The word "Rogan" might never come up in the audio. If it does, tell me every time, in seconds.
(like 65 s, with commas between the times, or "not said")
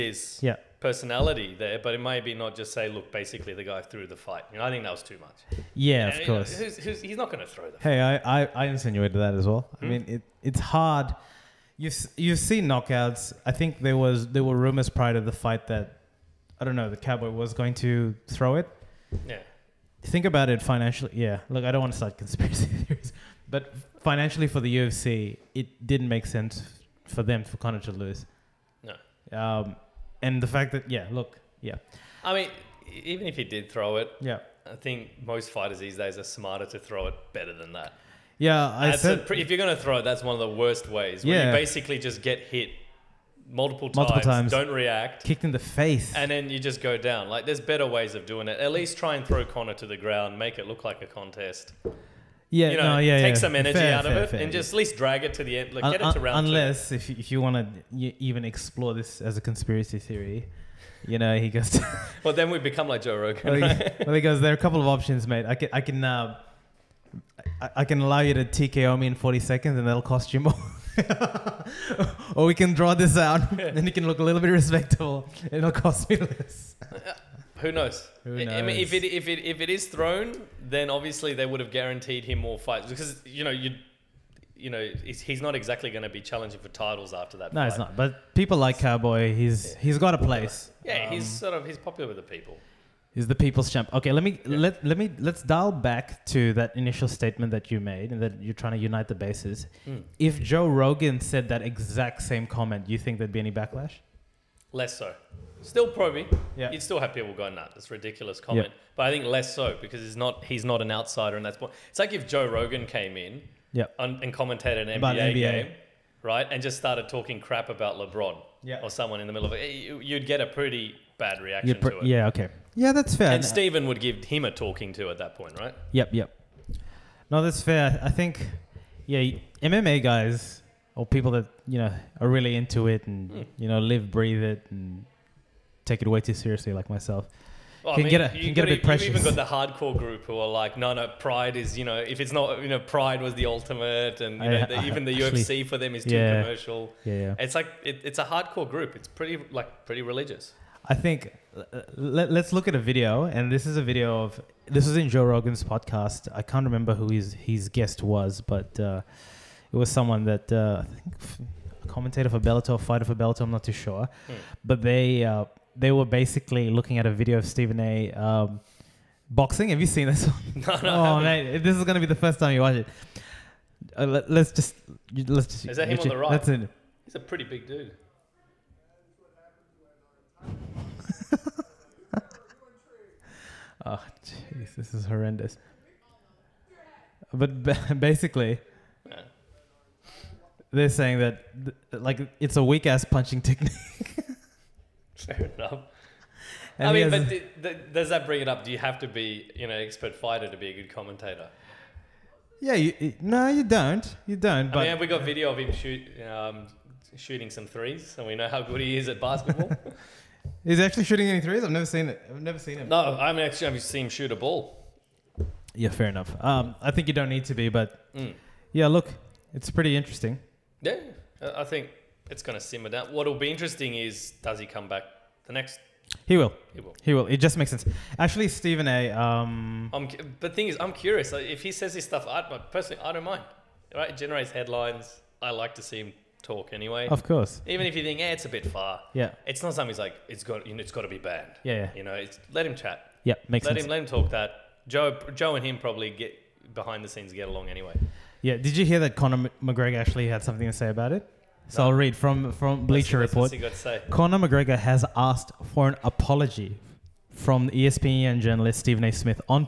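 63 s, 100 s, 112 s, 155 s.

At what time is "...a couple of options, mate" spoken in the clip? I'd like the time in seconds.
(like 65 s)
64 s.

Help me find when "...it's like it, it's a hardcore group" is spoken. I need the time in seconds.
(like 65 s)
147 s.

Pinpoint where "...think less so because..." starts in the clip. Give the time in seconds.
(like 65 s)
109 s.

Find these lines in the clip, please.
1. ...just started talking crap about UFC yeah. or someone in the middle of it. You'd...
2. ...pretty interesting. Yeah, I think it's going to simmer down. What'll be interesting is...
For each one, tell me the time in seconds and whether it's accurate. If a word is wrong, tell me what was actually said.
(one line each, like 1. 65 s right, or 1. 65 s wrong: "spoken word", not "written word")
1. 116 s wrong: "LeBron", not "UFC"
2. 219 s right.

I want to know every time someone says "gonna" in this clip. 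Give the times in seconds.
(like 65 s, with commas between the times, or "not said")
39 s, 171 s.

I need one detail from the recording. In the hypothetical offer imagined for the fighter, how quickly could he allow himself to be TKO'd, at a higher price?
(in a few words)
40 seconds.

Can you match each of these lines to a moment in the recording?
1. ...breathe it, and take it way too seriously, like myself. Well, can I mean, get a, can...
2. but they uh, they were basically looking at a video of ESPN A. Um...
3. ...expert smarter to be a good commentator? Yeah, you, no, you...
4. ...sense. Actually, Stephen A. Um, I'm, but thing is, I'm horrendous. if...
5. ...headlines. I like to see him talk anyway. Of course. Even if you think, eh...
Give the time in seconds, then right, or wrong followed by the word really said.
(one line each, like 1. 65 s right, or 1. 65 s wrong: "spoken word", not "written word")
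1. 134 s right
2. 164 s wrong: "Stephen", not "ESPN"
3. 199 s wrong: "fighter", not "smarter"
4. 227 s wrong: "curious", not "horrendous"
5. 234 s right.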